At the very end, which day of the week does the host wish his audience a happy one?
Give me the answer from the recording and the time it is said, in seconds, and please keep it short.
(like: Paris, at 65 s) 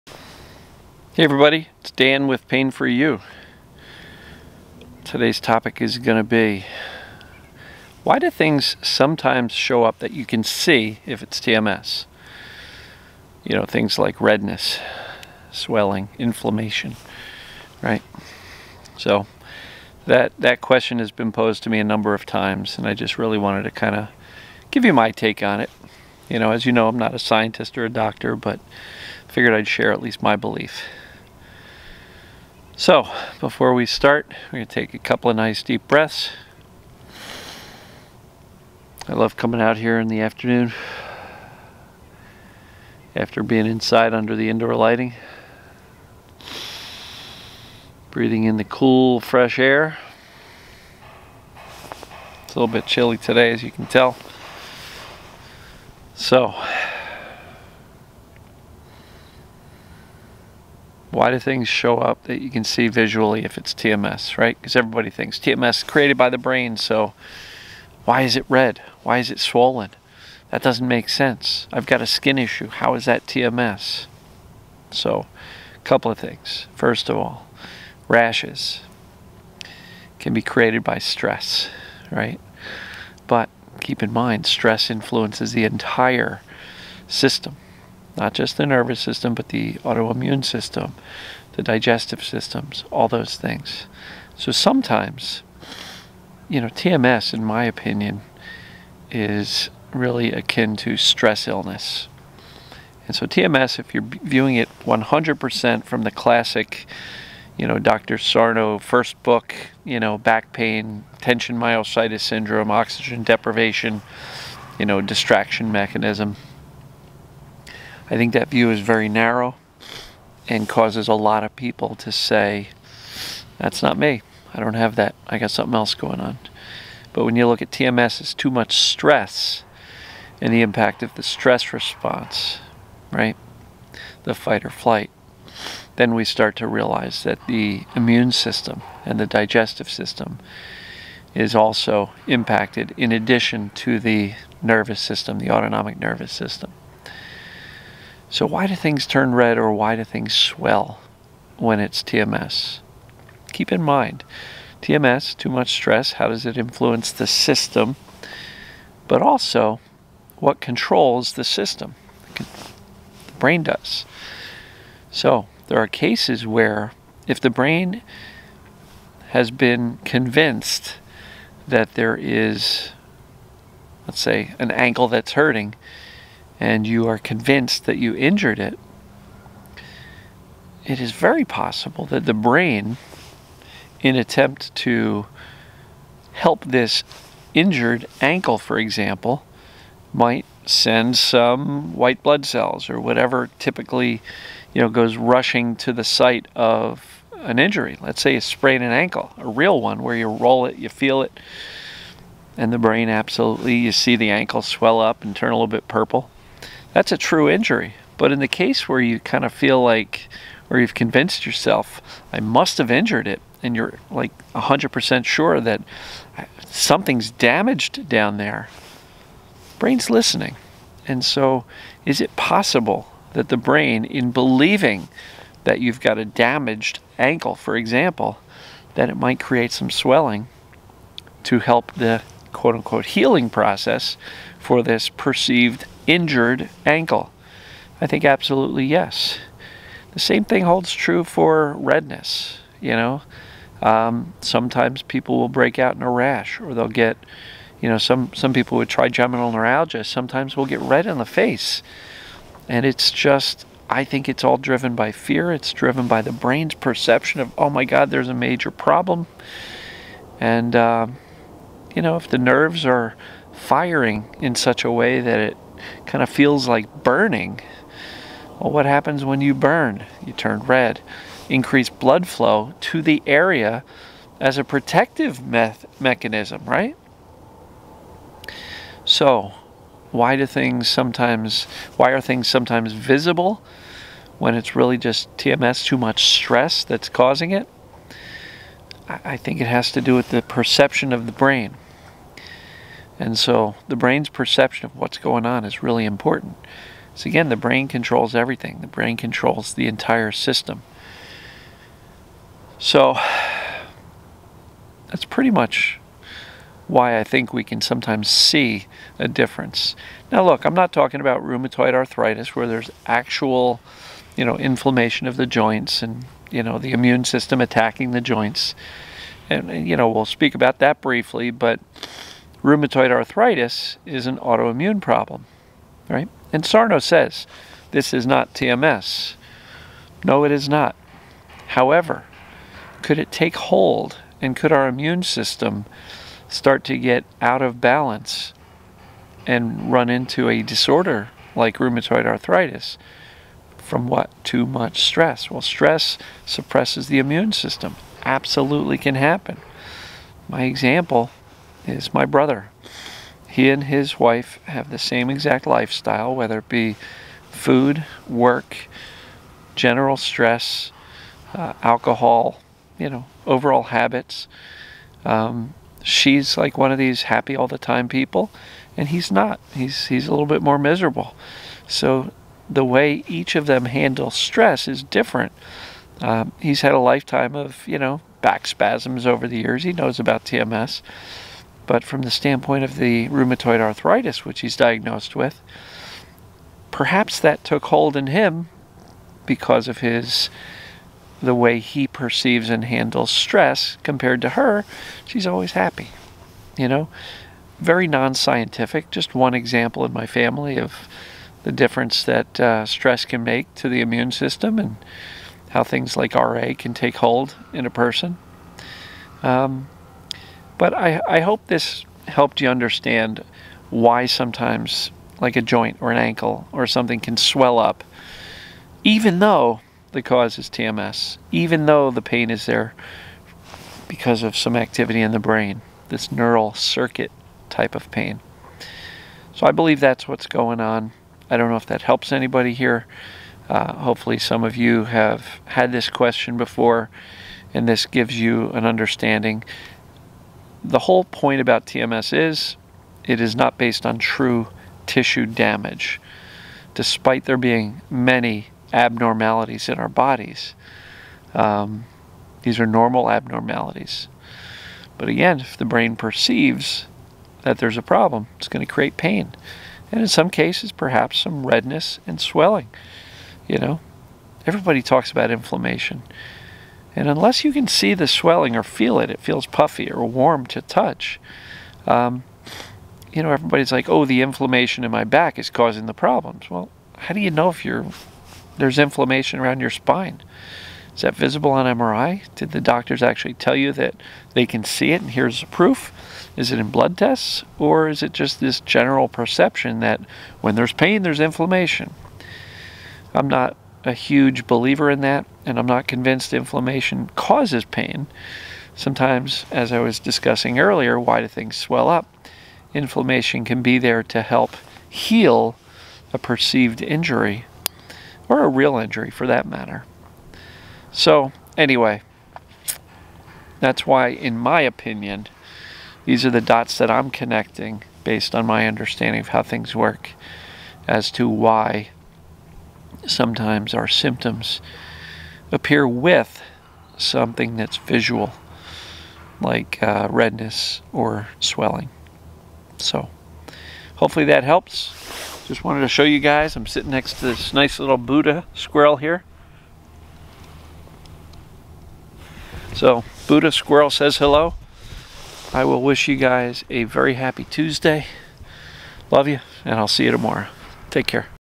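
Tuesday, at 547 s.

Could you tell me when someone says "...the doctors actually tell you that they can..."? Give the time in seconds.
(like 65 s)
482 s.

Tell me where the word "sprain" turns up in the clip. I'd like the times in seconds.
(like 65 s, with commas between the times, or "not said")
198 s.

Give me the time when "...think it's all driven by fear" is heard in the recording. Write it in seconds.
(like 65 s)
254 s.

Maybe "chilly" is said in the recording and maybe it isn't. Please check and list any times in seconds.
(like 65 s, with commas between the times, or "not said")
52 s.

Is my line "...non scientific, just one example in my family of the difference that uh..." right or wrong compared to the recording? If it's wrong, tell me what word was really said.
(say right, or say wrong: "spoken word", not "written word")
right.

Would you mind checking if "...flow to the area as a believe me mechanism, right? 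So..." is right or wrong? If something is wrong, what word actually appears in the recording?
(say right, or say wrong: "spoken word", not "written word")
wrong: "protective", not "believe".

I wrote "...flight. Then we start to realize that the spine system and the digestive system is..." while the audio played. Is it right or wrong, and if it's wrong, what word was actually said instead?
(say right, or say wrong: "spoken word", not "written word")
wrong: "immune", not "spine".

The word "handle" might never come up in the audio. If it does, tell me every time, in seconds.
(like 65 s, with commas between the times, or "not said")
373 s, 392 s.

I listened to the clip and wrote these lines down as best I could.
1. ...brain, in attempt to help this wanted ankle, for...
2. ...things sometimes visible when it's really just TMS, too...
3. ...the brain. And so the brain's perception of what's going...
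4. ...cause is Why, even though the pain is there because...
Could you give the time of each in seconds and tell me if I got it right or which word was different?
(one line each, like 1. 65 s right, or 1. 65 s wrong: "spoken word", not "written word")
1. 182 s wrong: "injured", not "wanted"
2. 282 s right
3. 291 s right
4. 420 s wrong: "TMS", not "Why".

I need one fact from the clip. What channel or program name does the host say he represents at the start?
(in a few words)
Pain Free You.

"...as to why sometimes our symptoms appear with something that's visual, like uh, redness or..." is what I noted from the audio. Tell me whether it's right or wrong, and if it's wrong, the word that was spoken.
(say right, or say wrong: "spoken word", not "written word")
right.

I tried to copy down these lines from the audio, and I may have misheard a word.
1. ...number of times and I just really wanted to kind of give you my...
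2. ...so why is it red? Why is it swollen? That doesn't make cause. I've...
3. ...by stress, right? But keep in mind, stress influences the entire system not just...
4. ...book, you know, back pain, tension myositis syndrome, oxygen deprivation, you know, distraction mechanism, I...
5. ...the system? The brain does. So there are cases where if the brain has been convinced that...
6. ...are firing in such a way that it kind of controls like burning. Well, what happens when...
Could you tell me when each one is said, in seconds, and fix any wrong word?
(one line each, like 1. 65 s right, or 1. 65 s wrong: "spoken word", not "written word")
1. 21 s right
2. 66 s wrong: "sense", not "cause"
3. 80 s right
4. 109 s right
5. 161 s right
6. 262 s wrong: "feels", not "controls".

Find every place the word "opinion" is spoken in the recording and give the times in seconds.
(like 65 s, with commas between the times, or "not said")
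97 s, 514 s.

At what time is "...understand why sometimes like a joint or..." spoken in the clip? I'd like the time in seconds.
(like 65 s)
412 s.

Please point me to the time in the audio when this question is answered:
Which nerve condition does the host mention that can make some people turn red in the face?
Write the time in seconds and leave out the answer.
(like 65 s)
248 s.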